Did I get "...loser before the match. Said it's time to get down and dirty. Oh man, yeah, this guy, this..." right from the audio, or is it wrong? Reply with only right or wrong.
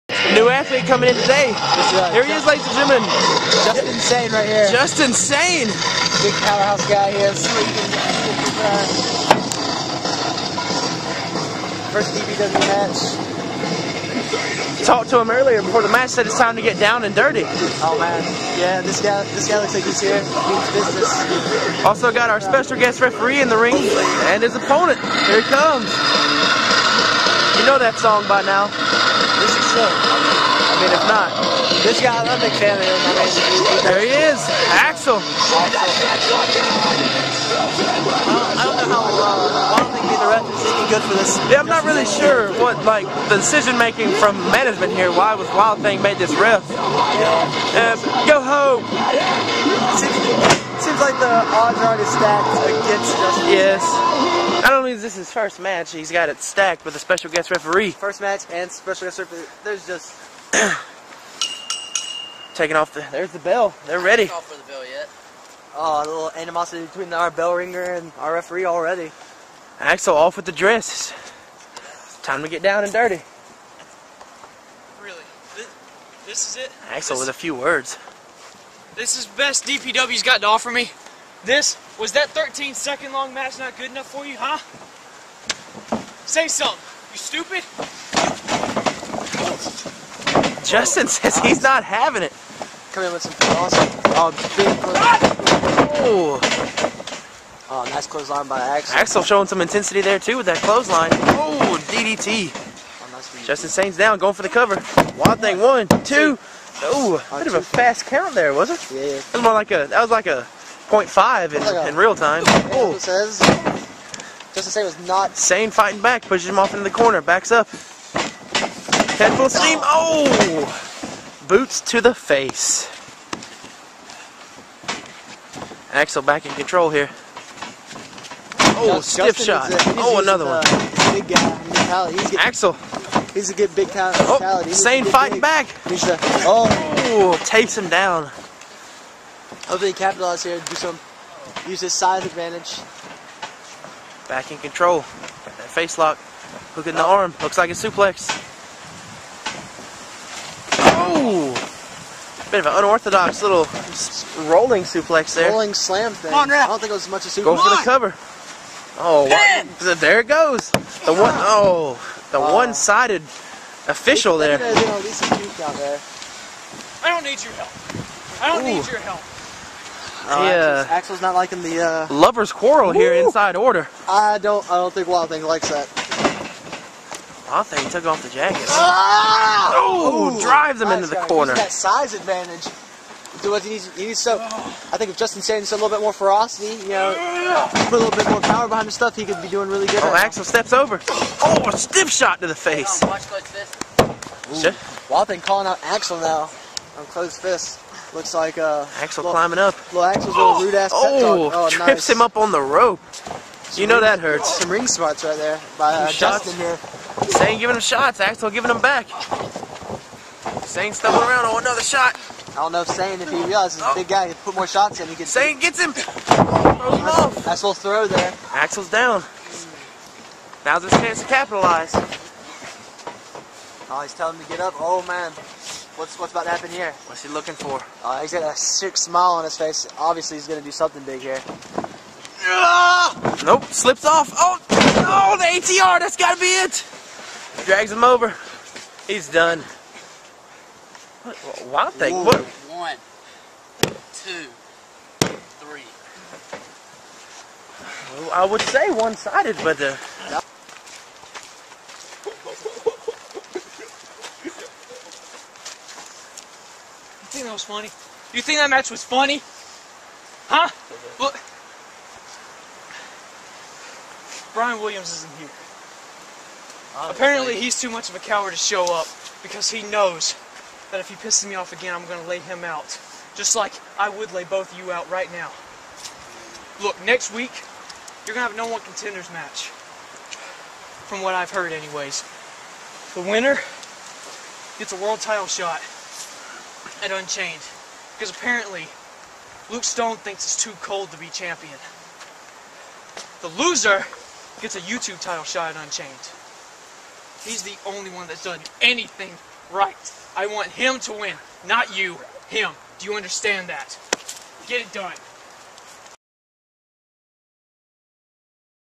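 wrong.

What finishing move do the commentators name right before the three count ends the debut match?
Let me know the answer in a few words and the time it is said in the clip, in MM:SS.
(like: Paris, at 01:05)
ATR, at 03:55.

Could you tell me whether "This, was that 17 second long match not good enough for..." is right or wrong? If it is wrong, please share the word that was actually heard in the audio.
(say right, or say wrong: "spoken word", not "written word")
wrong: "13", not "17".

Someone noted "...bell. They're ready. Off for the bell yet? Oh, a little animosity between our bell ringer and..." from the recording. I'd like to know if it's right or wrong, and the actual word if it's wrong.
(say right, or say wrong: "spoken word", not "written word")
right.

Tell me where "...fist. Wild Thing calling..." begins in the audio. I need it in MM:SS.
03:13.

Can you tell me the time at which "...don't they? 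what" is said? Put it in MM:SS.
04:01.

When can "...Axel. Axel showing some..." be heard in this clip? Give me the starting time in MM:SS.
01:38.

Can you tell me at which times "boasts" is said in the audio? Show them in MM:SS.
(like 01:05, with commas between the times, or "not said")
not said.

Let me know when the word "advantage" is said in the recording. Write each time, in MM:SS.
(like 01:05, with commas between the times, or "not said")
02:22, 03:02.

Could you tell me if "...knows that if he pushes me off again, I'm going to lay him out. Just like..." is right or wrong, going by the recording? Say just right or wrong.
wrong.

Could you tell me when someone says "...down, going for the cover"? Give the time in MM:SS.
01:43.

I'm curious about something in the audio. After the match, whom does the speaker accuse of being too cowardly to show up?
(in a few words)
Brian Williams.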